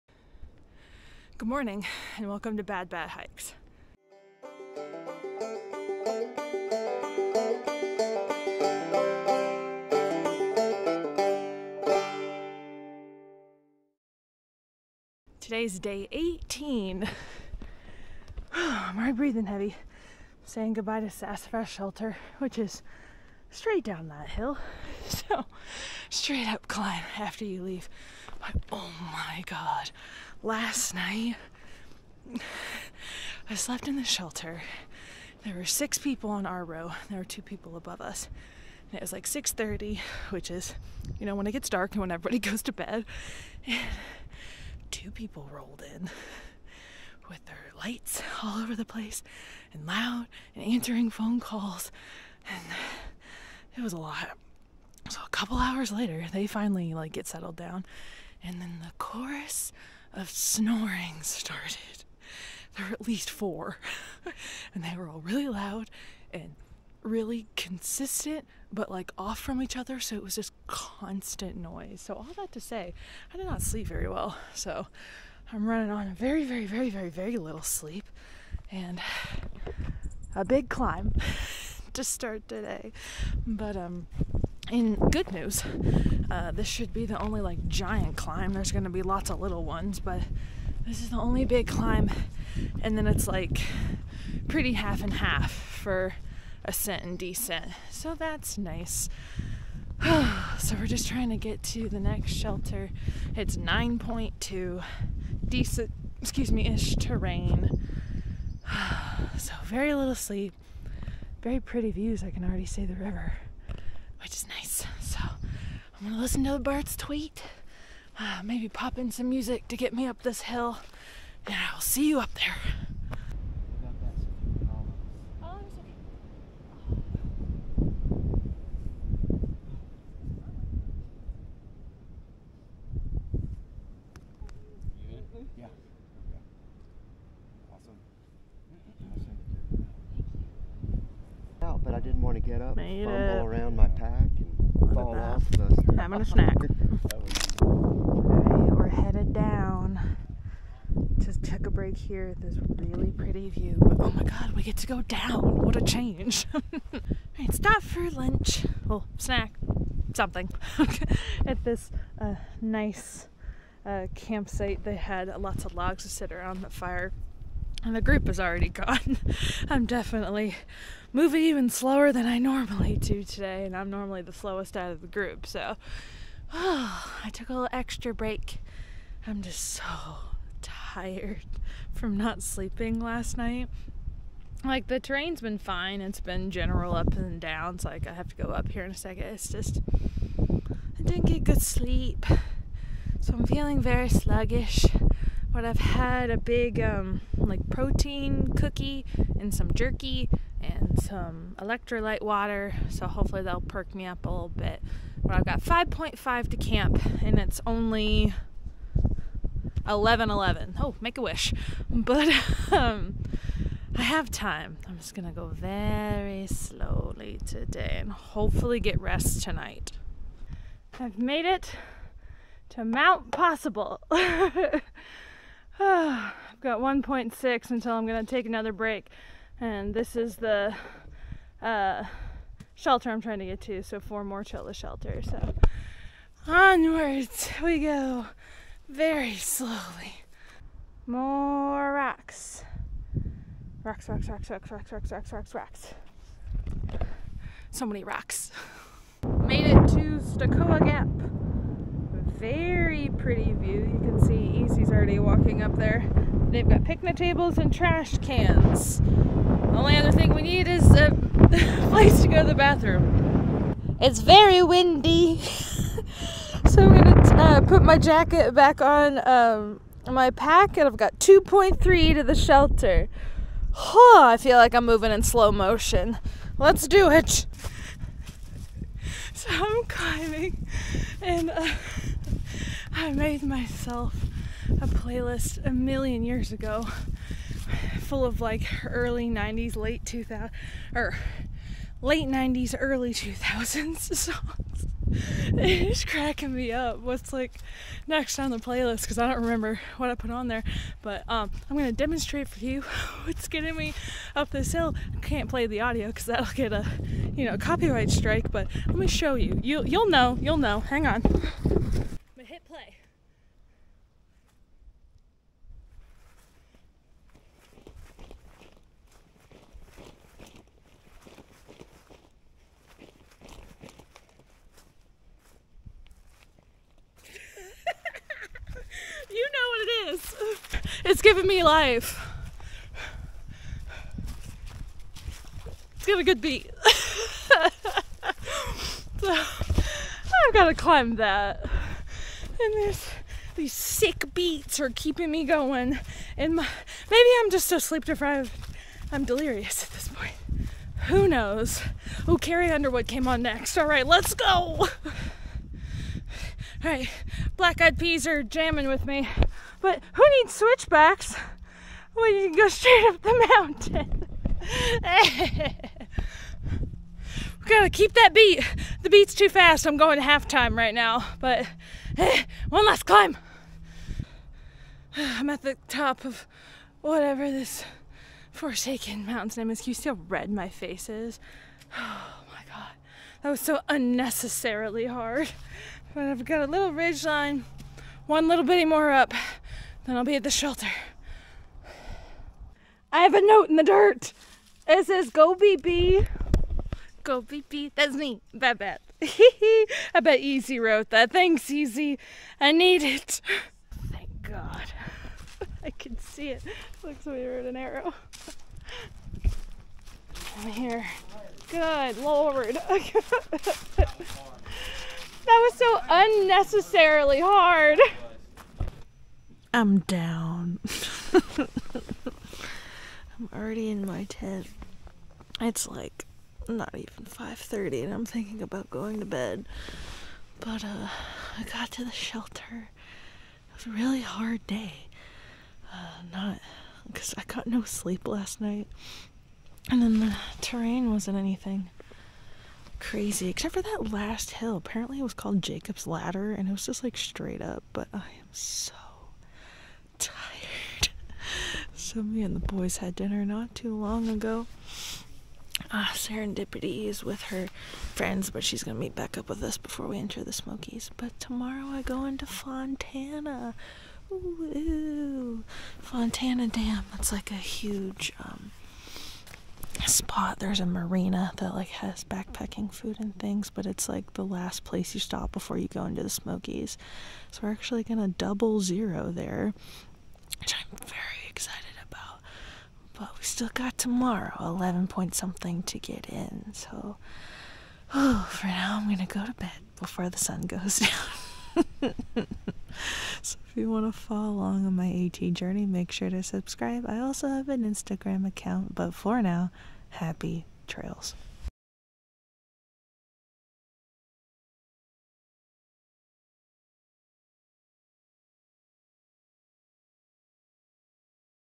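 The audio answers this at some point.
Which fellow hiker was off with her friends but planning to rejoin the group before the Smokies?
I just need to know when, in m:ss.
7:36.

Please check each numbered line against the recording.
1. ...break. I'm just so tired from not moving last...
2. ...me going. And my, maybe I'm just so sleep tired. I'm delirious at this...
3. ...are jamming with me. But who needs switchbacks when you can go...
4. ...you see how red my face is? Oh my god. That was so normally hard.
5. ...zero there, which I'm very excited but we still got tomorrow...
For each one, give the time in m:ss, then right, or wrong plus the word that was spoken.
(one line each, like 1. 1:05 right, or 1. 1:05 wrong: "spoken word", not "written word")
1. 2:58 wrong: "sleeping", not "moving"
2. 5:45 wrong: "deprived", not "tired"
3. 5:58 right
4. 6:19 wrong: "unnecessarily", not "normally"
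5. 7:58 right.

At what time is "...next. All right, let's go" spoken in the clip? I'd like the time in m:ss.
5:53.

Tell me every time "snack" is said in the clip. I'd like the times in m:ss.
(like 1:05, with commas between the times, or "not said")
2:26, 2:39.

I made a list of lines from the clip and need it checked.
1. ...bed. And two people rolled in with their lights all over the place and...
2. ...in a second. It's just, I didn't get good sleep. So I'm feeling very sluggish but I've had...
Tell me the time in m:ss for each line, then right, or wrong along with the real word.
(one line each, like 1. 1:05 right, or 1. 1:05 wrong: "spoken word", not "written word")
1. 0:42 right
2. 3:08 right.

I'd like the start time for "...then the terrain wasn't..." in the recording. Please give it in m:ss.
7:20.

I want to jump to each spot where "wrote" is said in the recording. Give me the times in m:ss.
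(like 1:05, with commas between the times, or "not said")
6:40, 6:47.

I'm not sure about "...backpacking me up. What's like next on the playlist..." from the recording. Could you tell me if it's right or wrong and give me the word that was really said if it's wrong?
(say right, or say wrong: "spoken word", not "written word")
wrong: "cracking", not "backpacking".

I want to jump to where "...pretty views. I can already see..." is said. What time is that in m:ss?
1:51.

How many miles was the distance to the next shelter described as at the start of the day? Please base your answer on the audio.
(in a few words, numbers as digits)
9.2.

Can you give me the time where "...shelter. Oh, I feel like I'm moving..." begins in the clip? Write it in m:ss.
4:32.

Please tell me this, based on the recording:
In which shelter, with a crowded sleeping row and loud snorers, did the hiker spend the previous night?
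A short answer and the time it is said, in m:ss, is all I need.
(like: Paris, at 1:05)
Sassafras Shelter, at 0:21.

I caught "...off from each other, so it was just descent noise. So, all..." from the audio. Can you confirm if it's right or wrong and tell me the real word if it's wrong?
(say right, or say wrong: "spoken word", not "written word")
wrong: "constant", not "descent".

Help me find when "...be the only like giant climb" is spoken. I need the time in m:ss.
1:26.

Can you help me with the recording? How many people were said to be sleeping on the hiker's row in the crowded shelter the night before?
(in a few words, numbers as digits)
6.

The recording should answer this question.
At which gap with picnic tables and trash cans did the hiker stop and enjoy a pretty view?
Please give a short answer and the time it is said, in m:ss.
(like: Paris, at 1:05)
Stecoah Gap, at 4:10.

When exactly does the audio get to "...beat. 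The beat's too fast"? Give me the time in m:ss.
6:08.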